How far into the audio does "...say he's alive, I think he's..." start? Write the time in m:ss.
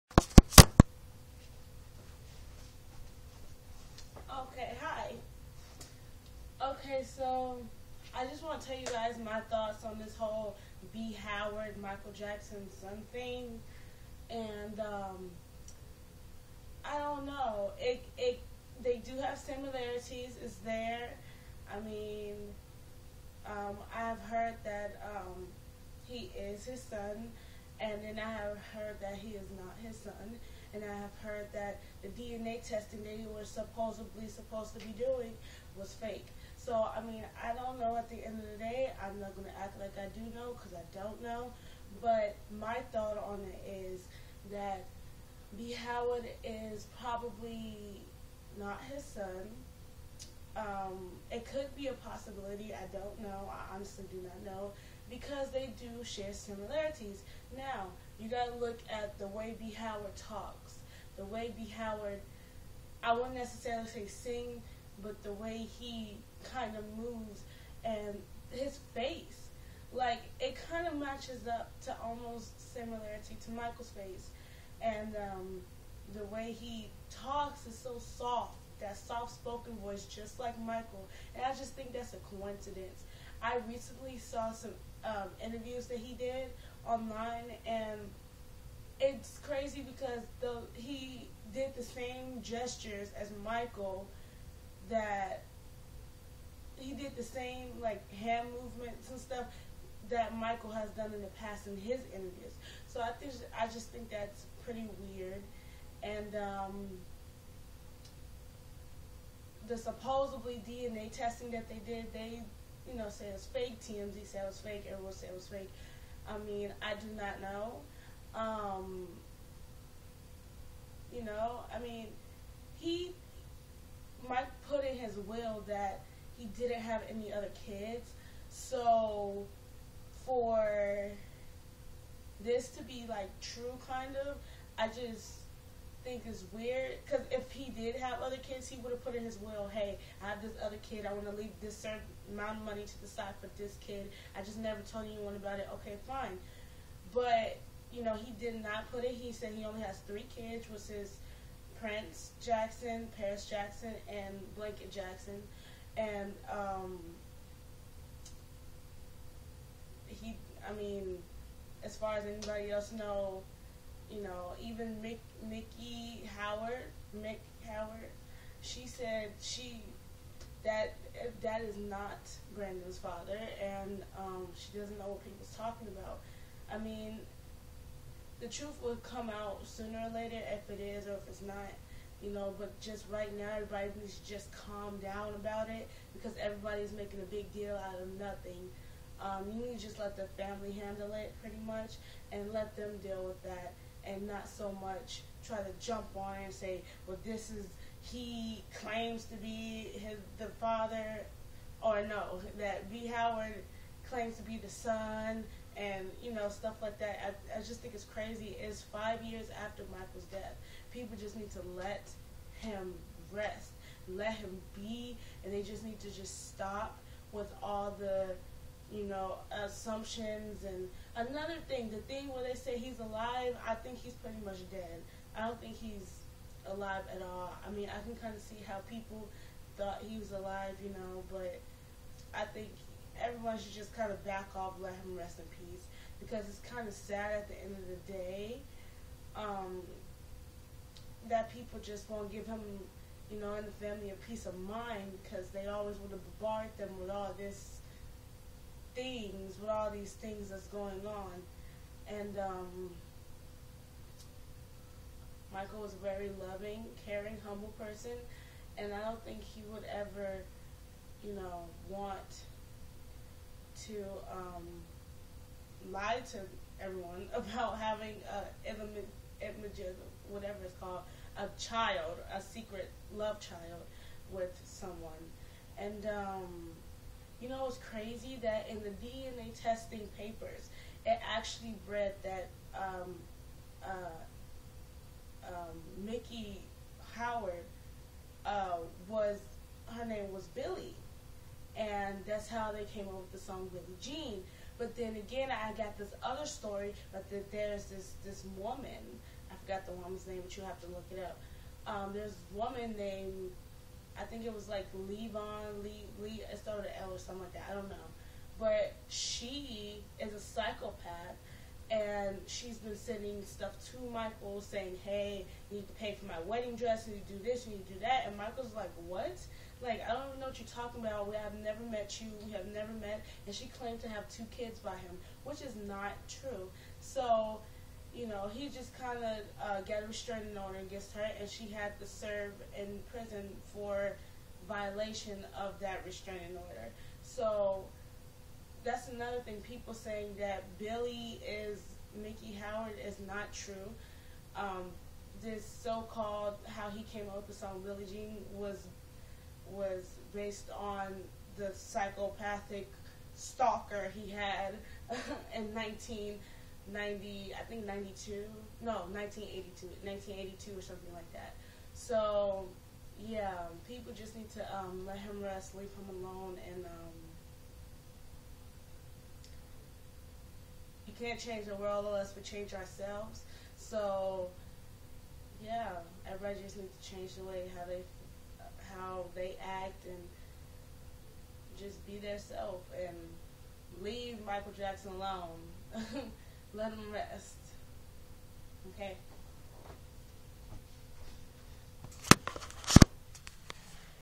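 3:42.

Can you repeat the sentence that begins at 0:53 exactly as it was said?
I honestly do not know because they do share similarities.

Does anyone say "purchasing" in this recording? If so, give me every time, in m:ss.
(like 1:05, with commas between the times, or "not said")
not said.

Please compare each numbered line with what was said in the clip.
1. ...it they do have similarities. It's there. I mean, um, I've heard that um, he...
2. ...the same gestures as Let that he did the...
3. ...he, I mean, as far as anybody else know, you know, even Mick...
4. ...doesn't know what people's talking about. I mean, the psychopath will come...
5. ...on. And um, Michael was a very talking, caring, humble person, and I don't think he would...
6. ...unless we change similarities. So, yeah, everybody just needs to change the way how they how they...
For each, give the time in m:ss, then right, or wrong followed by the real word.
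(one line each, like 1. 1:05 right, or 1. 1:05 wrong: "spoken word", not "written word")
1. 0:18 right
2. 1:31 wrong: "Michael", not "Let"
3. 2:40 right
4. 2:54 wrong: "truth", not "psychopath"
5. 4:11 wrong: "loving", not "talking"
6. 6:12 wrong: "ourselves", not "similarities".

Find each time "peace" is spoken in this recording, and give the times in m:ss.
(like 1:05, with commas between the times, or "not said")
3:55, 4:04.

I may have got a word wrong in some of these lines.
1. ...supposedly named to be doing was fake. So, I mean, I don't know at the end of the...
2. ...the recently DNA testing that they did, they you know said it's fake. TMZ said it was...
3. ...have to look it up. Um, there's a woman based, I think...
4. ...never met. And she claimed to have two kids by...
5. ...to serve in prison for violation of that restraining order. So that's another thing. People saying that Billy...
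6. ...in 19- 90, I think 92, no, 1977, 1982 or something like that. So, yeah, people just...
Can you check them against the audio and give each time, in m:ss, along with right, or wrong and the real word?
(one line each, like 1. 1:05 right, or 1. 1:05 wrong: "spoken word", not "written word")
1. 0:33 wrong: "supposed", not "named"
2. 1:49 wrong: "supposedly", not "recently"
3. 5:00 wrong: "named", not "based"
4. 5:22 right
5. 5:31 right
6. 5:55 wrong: "1982", not "1977".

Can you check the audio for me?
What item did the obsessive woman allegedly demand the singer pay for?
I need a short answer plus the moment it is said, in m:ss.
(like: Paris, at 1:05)
Wedding dress, at 5:16.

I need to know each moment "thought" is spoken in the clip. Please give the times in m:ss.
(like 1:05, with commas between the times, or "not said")
0:09, 0:42, 3:49.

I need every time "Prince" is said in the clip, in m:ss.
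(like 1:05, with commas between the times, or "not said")
2:31.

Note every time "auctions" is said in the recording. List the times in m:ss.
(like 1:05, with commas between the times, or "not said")
not said.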